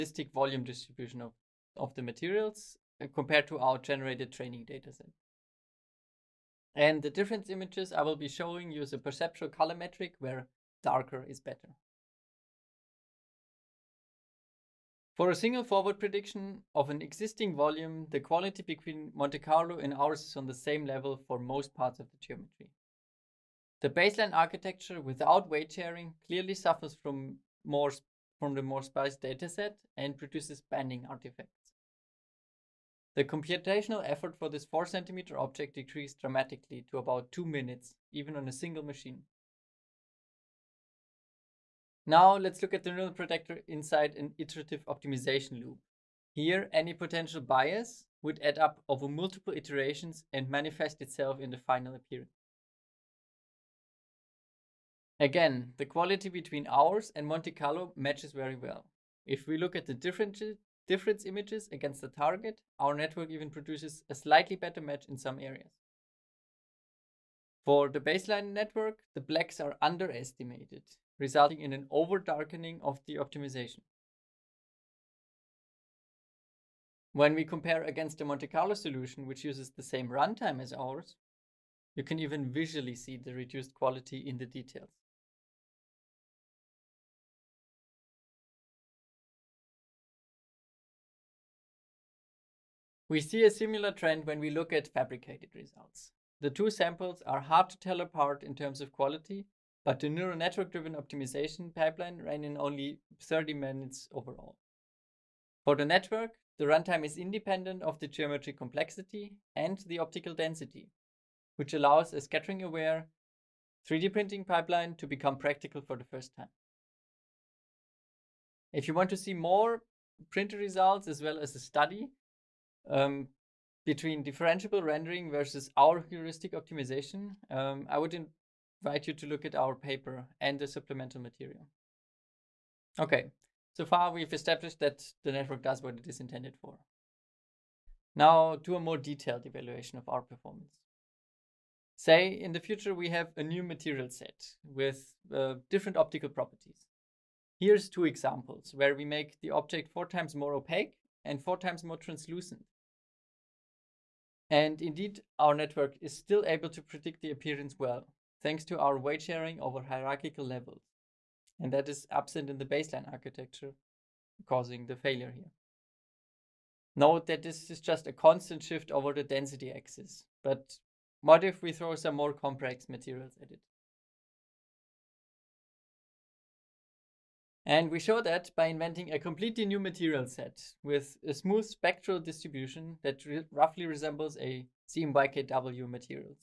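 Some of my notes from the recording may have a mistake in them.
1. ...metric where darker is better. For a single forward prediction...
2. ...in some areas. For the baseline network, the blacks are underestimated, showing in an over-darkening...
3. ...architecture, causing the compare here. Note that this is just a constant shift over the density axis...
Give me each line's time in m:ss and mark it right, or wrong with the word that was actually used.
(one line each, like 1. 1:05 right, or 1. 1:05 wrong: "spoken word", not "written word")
1. 0:09 right
2. 1:05 wrong: "resulting", not "showing"
3. 2:43 wrong: "failure", not "compare".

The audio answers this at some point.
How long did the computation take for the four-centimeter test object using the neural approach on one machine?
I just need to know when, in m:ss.
0:36.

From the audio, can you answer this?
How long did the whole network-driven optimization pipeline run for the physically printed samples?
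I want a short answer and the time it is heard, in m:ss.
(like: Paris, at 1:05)
30 minutes, at 1:43.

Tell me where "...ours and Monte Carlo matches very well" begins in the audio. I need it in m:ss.
0:56.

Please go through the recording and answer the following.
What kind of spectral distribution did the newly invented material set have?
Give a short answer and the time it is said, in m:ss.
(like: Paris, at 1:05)
smooth, at 3:01.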